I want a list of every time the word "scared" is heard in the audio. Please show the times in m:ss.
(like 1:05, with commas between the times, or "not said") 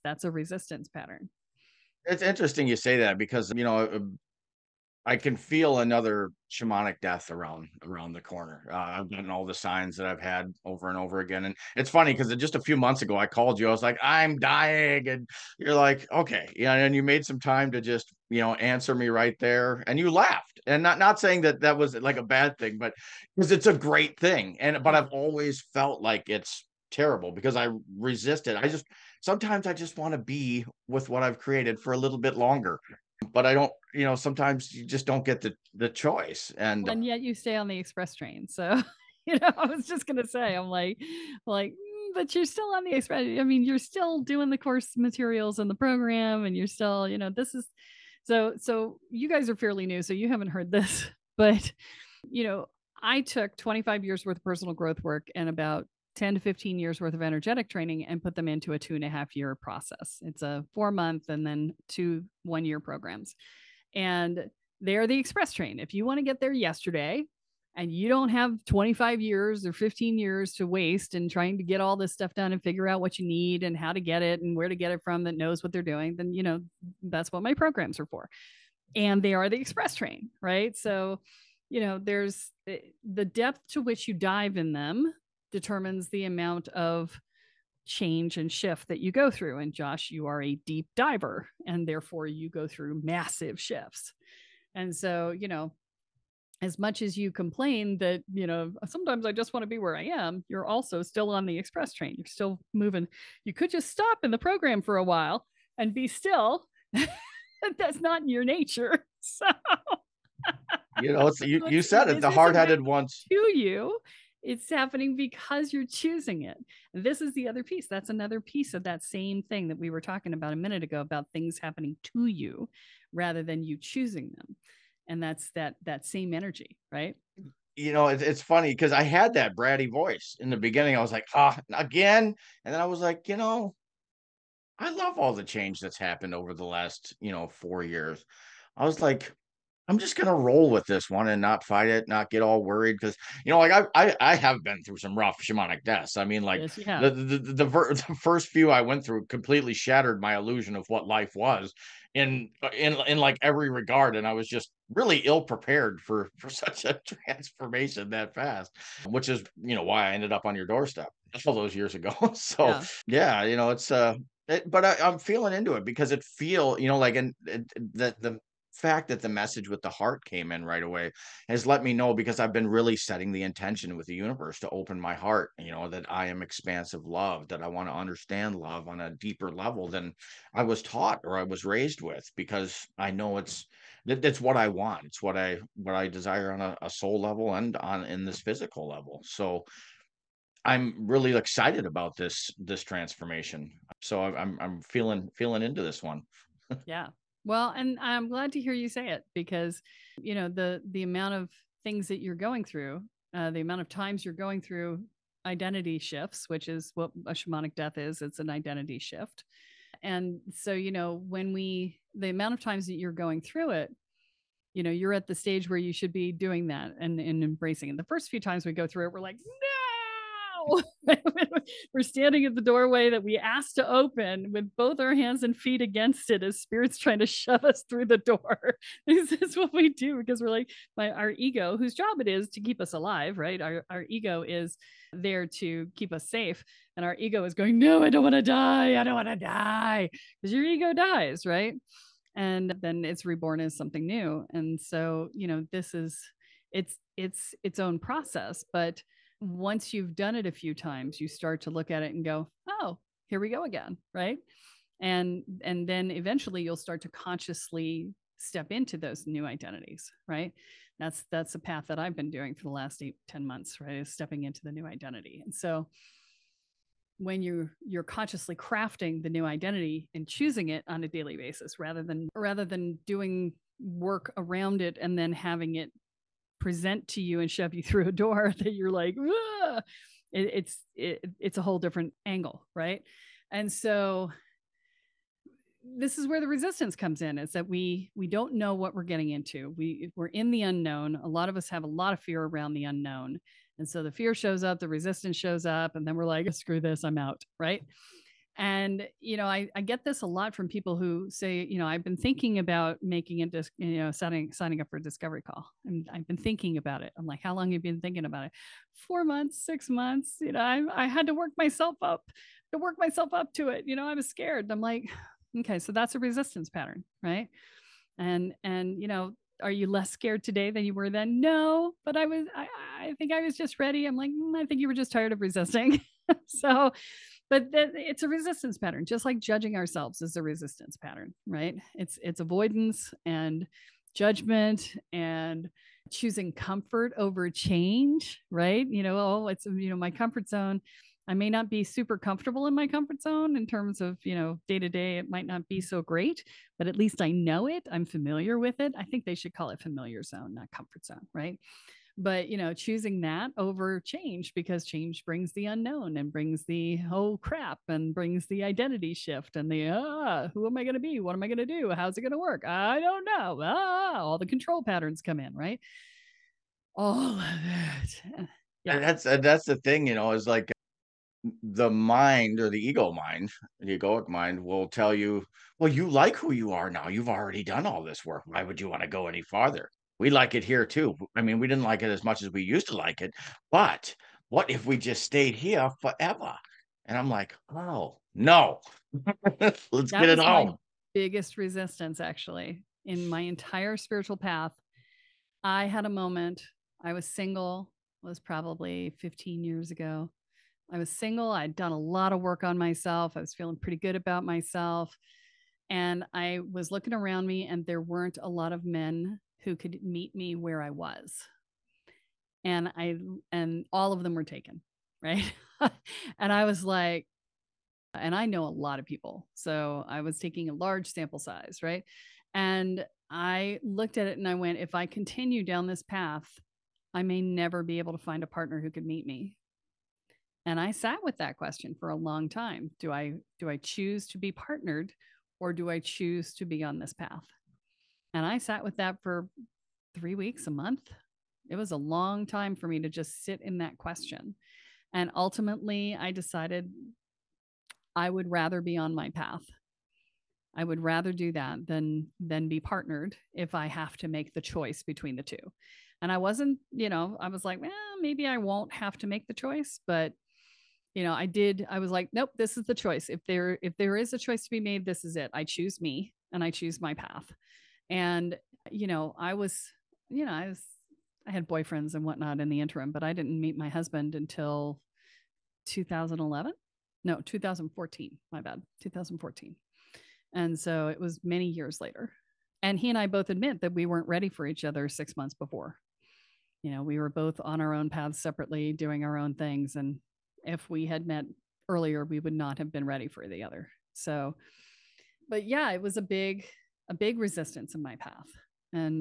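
5:14, 5:20.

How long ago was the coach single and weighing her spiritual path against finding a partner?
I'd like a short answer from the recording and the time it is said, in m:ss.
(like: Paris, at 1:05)
15 years ago, at 6:39.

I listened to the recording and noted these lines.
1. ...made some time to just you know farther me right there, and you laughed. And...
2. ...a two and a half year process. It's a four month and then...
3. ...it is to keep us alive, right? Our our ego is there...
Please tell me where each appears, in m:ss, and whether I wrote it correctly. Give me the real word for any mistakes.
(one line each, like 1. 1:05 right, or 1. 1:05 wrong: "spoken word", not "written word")
1. 0:17 wrong: "answer", not "farther"
2. 0:58 right
3. 3:52 right.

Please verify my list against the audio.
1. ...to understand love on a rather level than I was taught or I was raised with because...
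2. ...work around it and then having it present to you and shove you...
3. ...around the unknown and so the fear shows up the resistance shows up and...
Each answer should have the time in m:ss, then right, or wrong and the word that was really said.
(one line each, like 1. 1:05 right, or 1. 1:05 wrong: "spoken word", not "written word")
1. 2:57 wrong: "deeper", not "rather"
2. 4:33 right
3. 4:52 right.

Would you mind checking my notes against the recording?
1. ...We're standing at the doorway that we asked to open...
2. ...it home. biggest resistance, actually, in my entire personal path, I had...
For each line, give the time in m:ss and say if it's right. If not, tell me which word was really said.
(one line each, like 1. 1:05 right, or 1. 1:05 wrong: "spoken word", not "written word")
1. 3:41 right
2. 6:30 wrong: "spiritual", not "personal".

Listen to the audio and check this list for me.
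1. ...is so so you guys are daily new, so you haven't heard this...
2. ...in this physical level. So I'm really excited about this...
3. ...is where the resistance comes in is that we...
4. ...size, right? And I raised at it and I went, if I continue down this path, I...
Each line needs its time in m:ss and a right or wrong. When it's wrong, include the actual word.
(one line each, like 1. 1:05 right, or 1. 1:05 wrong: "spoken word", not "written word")
1. 0:47 wrong: "fairly", not "daily"
2. 3:08 right
3. 4:46 right
4. 7:01 wrong: "looked", not "raised".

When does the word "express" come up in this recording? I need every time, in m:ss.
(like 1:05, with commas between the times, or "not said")
0:37, 0:42, 1:05, 1:19, 1:41.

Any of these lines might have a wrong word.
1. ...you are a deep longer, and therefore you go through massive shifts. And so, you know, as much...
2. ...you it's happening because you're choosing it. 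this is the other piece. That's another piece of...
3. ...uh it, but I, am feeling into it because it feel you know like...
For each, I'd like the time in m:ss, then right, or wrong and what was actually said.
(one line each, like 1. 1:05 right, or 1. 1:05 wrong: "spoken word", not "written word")
1. 1:30 wrong: "diver", not "longer"
2. 1:53 right
3. 2:43 right.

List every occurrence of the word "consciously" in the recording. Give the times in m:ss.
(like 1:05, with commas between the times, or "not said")
4:17, 4:28.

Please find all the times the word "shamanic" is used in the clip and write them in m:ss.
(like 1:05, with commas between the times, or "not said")
0:06, 2:25, 3:27.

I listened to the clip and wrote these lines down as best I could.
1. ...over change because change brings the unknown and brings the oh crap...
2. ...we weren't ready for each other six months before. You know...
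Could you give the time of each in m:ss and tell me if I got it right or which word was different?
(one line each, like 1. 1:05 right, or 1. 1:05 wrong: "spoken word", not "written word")
1. 5:53 right
2. 8:03 right.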